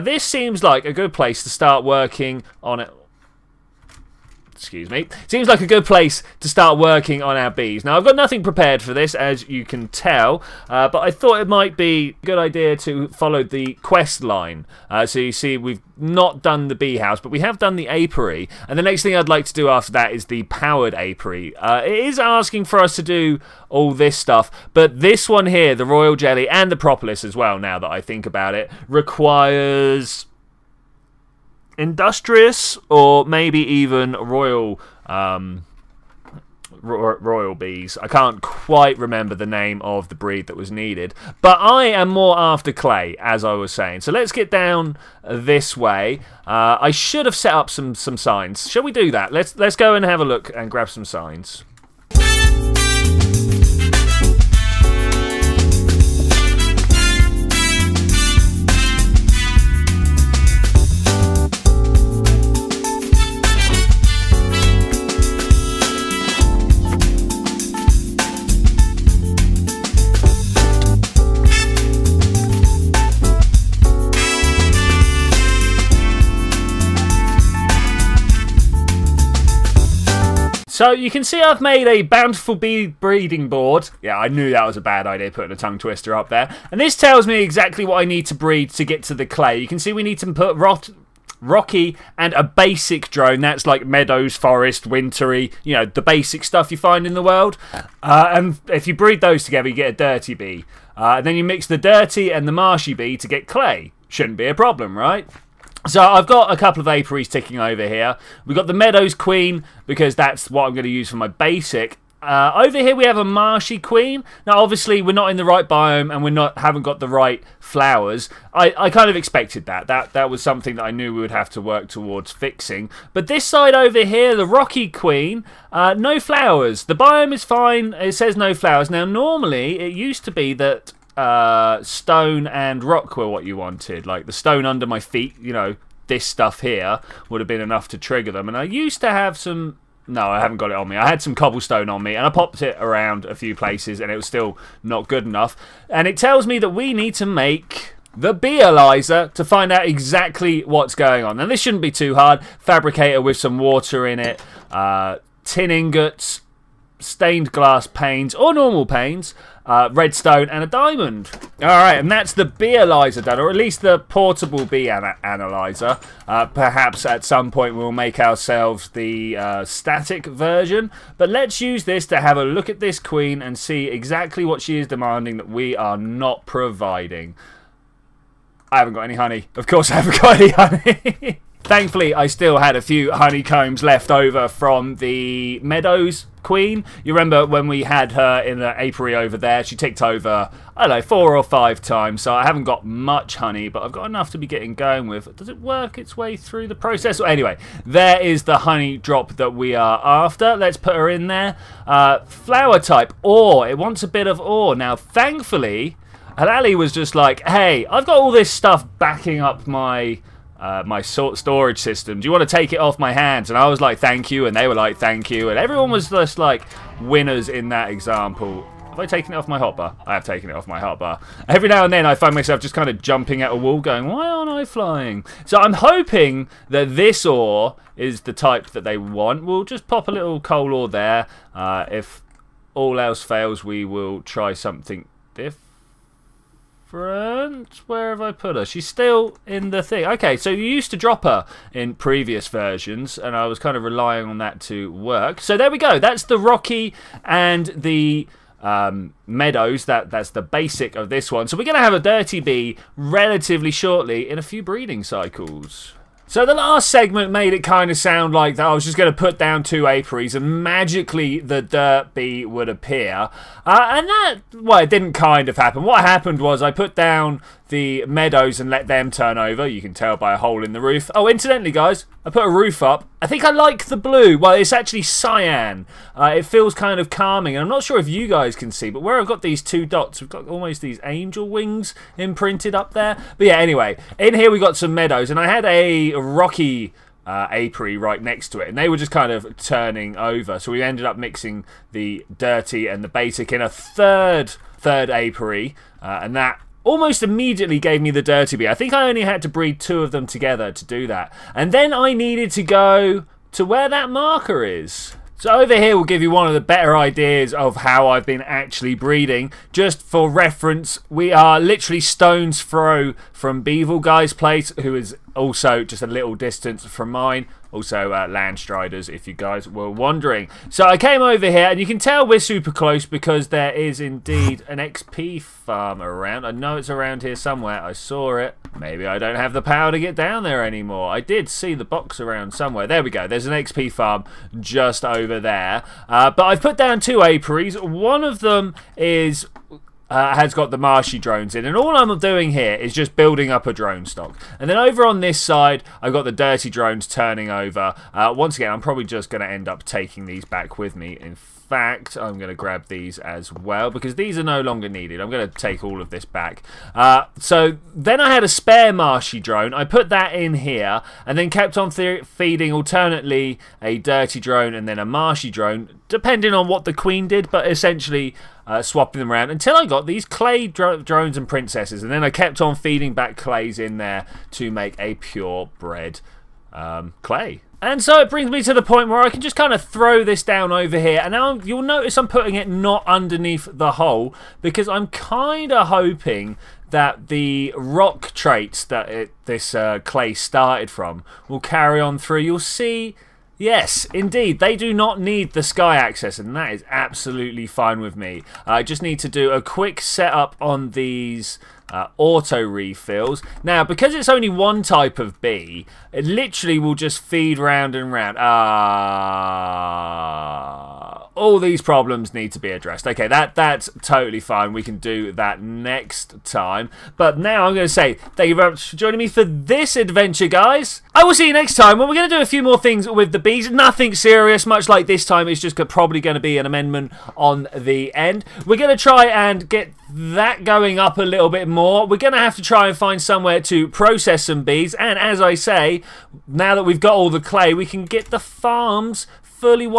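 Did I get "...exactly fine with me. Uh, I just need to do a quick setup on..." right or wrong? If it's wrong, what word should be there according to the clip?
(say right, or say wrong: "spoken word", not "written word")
wrong: "absolutely", not "exactly".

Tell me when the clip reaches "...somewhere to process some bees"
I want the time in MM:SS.
07:13.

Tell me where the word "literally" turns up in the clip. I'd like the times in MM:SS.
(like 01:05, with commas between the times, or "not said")
05:11, 06:46.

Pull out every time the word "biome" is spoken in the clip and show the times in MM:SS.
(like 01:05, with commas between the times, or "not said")
01:55, 02:06.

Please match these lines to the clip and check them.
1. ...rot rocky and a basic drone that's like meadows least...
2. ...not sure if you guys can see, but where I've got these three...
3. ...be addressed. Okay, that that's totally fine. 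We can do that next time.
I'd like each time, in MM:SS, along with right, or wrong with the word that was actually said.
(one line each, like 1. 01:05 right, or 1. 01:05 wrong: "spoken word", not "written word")
1. 01:30 wrong: "forest", not "least"
2. 04:37 wrong: "two", not "three"
3. 06:52 right.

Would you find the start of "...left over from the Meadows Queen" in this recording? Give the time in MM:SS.
03:03.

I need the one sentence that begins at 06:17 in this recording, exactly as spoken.
And so it brings me to the point where I can just kind of throw this down over here.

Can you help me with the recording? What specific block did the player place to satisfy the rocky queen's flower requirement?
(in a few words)
coal ore.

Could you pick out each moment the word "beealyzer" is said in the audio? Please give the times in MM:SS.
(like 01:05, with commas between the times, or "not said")
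02:28, 02:42.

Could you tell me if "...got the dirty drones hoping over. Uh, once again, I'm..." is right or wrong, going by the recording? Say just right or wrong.
wrong.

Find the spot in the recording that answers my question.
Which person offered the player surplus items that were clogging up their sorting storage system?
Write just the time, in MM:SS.
03:26.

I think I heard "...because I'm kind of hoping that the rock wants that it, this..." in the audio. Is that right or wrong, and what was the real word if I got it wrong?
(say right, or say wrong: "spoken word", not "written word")
wrong: "traits", not "wants".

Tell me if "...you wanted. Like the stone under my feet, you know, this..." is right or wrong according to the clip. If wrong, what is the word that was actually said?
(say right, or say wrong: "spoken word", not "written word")
right.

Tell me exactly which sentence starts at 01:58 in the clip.
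I, I kind of expected that.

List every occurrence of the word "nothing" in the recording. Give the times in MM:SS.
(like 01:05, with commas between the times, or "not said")
00:08, 07:03.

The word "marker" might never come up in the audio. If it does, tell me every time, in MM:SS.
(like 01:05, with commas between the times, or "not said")
05:04.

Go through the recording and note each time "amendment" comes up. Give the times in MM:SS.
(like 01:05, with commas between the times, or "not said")
07:06.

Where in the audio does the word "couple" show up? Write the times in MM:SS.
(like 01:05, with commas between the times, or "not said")
01:46.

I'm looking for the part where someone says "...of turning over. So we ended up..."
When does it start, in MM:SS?
04:49.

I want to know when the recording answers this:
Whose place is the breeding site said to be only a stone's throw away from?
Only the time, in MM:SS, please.
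05:13.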